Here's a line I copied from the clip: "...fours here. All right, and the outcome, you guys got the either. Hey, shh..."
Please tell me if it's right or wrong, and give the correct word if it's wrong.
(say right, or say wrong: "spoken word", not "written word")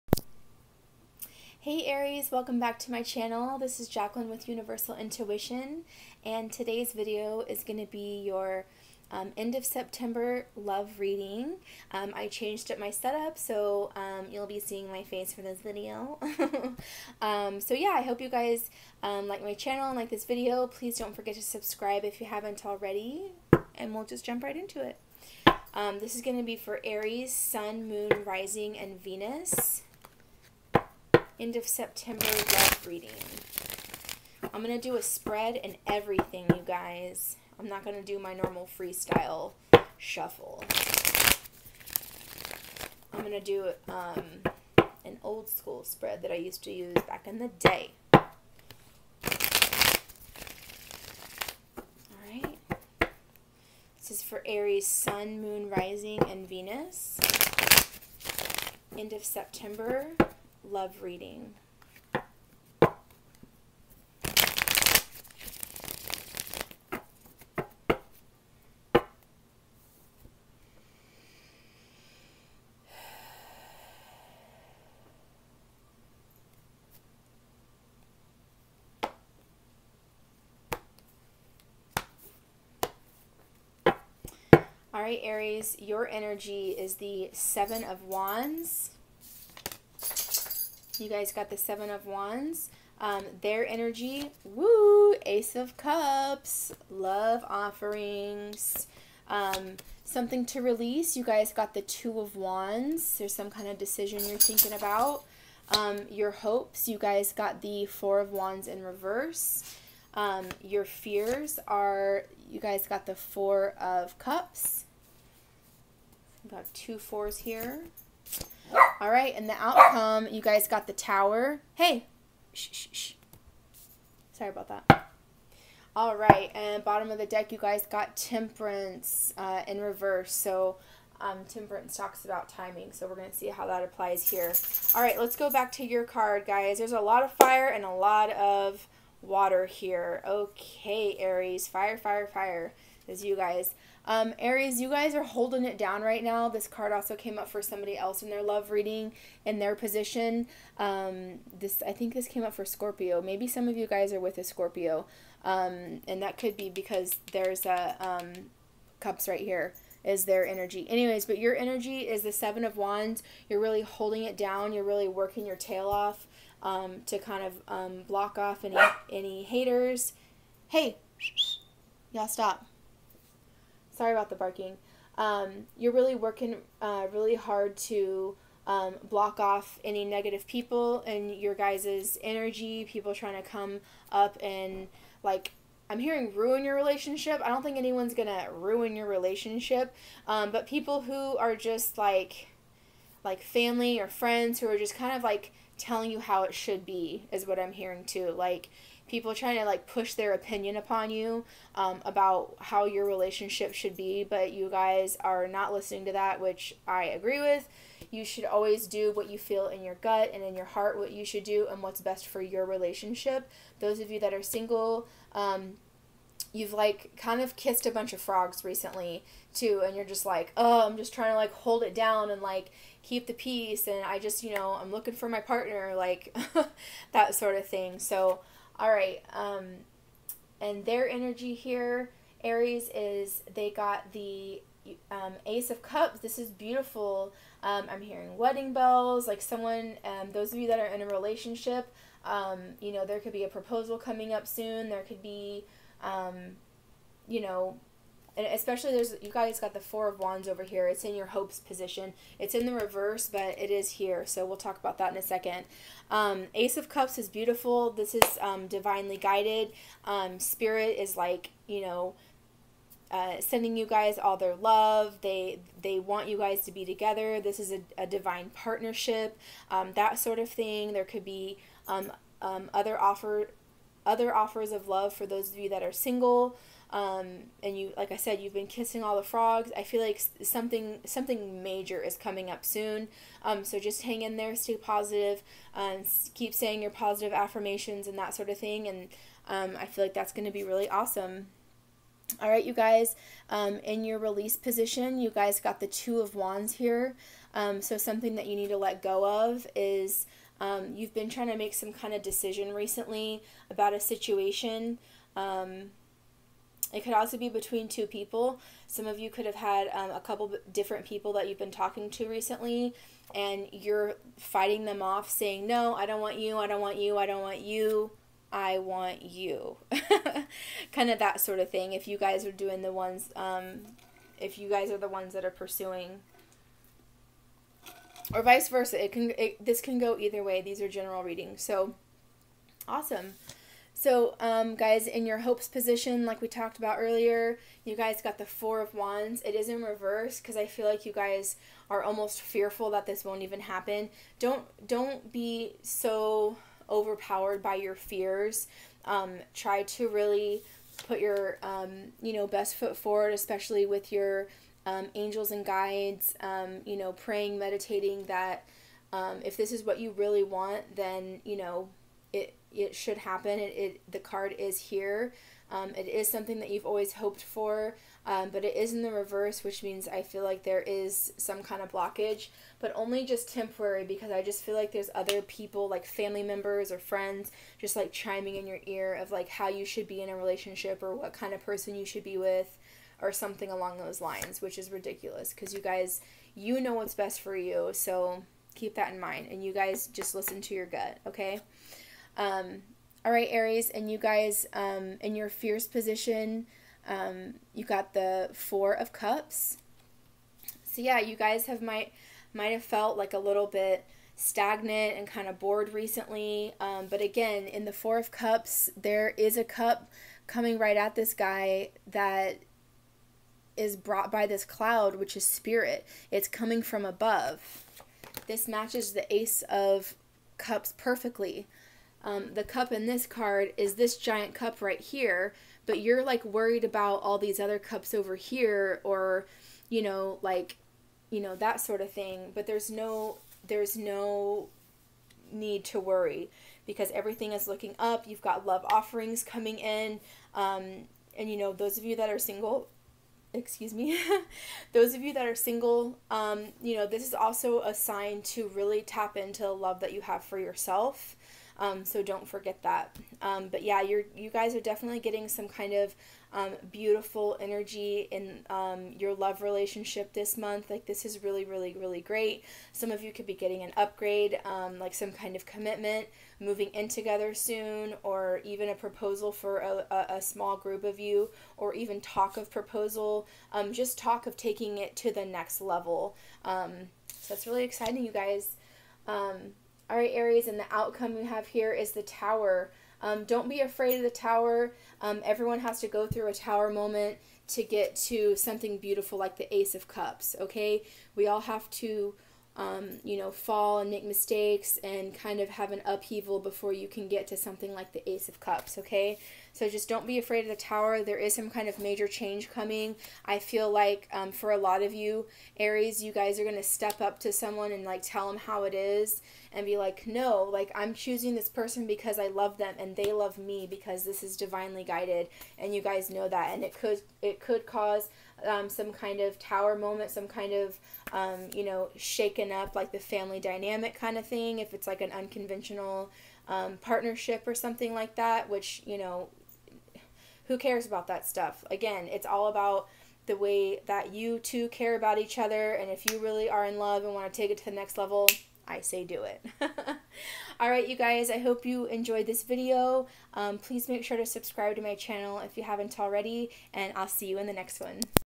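wrong: "tower", not "either".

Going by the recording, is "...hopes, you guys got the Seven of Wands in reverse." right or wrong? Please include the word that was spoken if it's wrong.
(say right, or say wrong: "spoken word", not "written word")
wrong: "Four", not "Seven".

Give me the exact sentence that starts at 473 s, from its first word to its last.
Um, just talk of taking it to the next level.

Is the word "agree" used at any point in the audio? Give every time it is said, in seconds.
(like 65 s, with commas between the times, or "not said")
207 s.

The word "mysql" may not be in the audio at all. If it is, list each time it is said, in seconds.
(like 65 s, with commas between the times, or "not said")
not said.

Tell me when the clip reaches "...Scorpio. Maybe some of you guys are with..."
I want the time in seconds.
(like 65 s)
152 s.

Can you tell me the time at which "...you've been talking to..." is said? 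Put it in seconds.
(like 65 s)
311 s.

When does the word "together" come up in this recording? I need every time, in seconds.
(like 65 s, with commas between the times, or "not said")
266 s, 467 s.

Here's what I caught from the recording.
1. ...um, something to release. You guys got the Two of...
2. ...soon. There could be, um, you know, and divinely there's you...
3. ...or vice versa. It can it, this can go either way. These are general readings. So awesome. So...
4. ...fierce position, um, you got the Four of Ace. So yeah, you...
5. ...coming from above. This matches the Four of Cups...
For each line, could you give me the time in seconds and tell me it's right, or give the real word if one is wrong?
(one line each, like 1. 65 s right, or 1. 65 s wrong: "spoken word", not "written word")
1. 99 s right
2. 244 s wrong: "especially", not "divinely"
3. 328 s right
4. 395 s wrong: "Cups", not "Ace"
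5. 416 s wrong: "Ace", not "Four".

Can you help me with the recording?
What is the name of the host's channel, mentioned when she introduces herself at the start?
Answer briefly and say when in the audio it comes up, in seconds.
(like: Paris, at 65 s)
Universal Intuition, at 4 s.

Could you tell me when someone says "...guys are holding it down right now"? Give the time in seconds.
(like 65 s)
144 s.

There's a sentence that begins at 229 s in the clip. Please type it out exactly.
Um, and their energy here, Aries, is they got the um, Ace of Cups.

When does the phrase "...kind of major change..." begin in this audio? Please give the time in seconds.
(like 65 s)
501 s.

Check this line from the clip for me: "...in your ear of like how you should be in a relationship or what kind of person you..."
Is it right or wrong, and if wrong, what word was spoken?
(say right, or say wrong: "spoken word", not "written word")
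right.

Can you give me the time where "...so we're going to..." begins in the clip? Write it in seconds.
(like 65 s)
132 s.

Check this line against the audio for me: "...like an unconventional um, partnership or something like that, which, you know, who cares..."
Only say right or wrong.
right.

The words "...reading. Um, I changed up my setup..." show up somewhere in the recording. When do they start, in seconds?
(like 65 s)
10 s.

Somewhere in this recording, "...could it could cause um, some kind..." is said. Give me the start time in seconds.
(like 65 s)
516 s.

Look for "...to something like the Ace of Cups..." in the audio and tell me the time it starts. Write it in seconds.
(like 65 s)
497 s.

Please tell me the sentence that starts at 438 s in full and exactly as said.
You've got love offerings coming in.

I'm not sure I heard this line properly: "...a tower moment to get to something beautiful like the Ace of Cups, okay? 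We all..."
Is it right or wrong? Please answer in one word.
right.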